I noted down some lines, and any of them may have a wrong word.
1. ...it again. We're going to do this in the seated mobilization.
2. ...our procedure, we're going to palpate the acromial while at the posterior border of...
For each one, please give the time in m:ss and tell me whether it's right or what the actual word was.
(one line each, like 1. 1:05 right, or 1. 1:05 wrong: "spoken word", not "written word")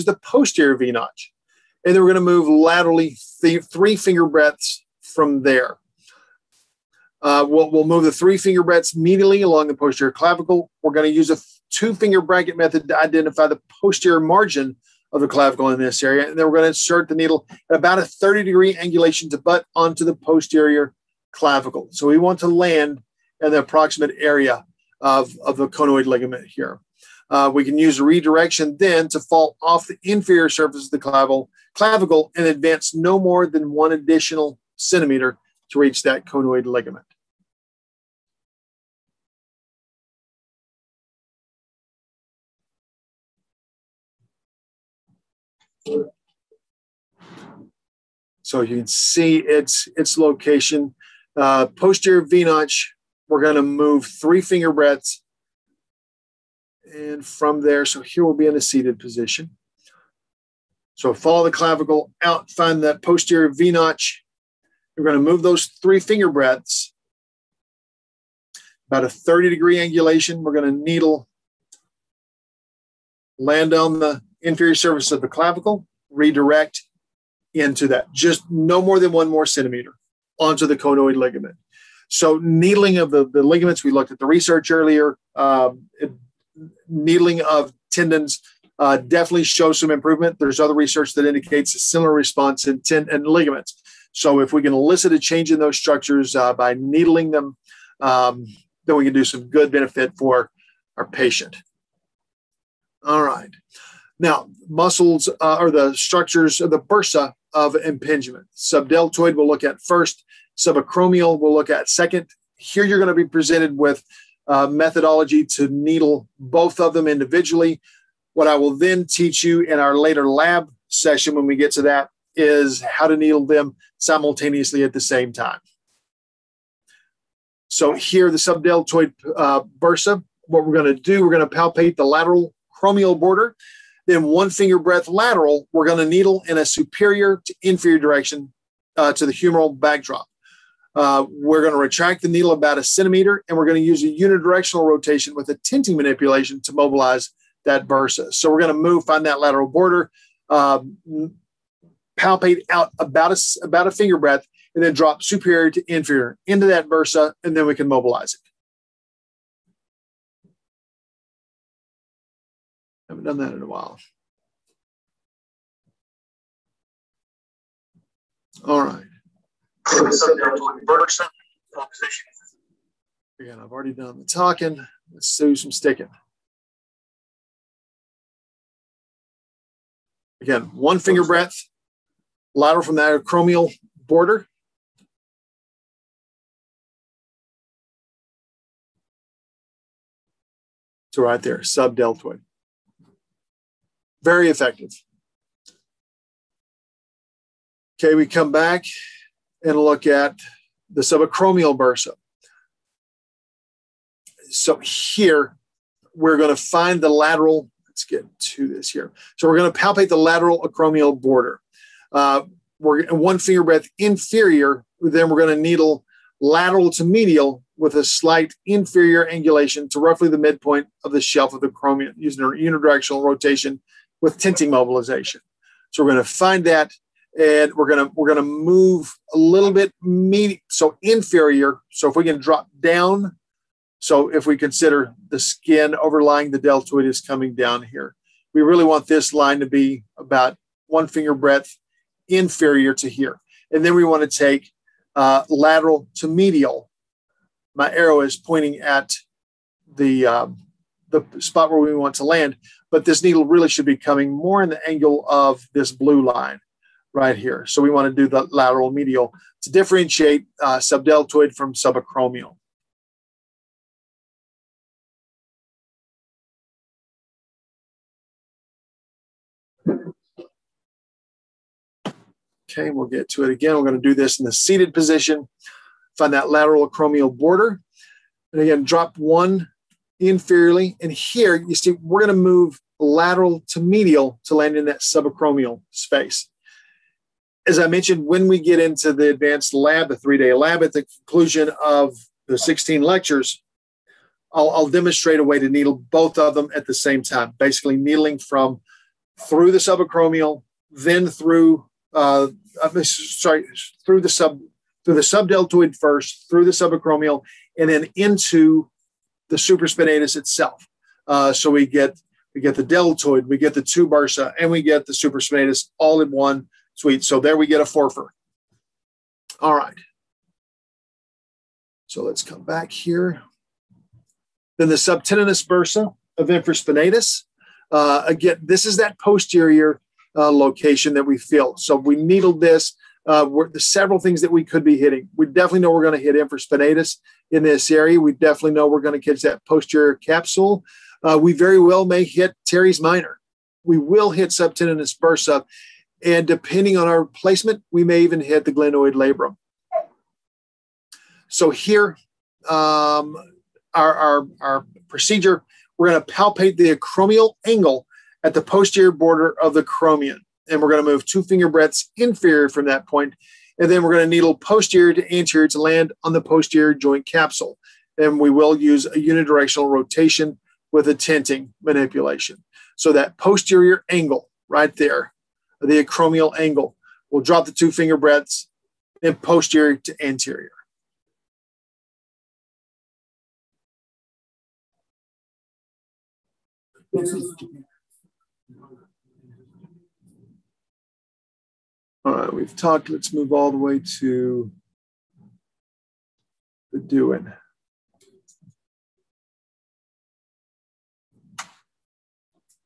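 1. 4:33 wrong: "position", not "mobilization"
2. 5:54 wrong: "angle", not "while".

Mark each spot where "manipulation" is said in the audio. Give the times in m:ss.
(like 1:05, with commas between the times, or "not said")
2:25, 6:11.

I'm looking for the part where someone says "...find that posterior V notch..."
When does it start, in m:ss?
1:02.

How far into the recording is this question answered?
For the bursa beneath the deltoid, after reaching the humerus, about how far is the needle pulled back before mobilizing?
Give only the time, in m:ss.
2:22.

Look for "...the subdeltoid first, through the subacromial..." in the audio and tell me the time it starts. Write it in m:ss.
5:05.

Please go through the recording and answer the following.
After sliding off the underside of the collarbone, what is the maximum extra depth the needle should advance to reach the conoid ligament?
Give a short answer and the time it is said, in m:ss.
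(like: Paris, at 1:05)
1 centimeter, at 0:33.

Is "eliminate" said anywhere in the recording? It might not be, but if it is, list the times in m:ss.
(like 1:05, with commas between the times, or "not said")
not said.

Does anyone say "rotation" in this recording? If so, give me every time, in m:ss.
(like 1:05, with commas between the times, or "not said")
2:24, 3:43, 6:09.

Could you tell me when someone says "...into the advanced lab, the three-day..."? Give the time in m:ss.
4:48.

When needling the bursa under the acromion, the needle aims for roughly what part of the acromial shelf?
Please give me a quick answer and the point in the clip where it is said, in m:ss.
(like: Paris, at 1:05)
The midpoint, at 3:40.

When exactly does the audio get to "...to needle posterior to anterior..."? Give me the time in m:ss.
6:04.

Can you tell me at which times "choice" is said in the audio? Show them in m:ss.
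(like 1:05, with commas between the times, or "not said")
not said.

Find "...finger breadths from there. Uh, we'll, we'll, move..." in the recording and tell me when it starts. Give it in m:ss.
0:03.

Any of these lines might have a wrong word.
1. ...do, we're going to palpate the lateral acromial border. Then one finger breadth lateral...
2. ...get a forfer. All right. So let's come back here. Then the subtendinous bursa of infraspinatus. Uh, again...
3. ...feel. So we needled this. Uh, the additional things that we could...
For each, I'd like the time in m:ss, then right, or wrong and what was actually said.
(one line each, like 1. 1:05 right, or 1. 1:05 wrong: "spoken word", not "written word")
1. 2:11 right
2. 5:17 right
3. 5:31 wrong: "several", not "additional".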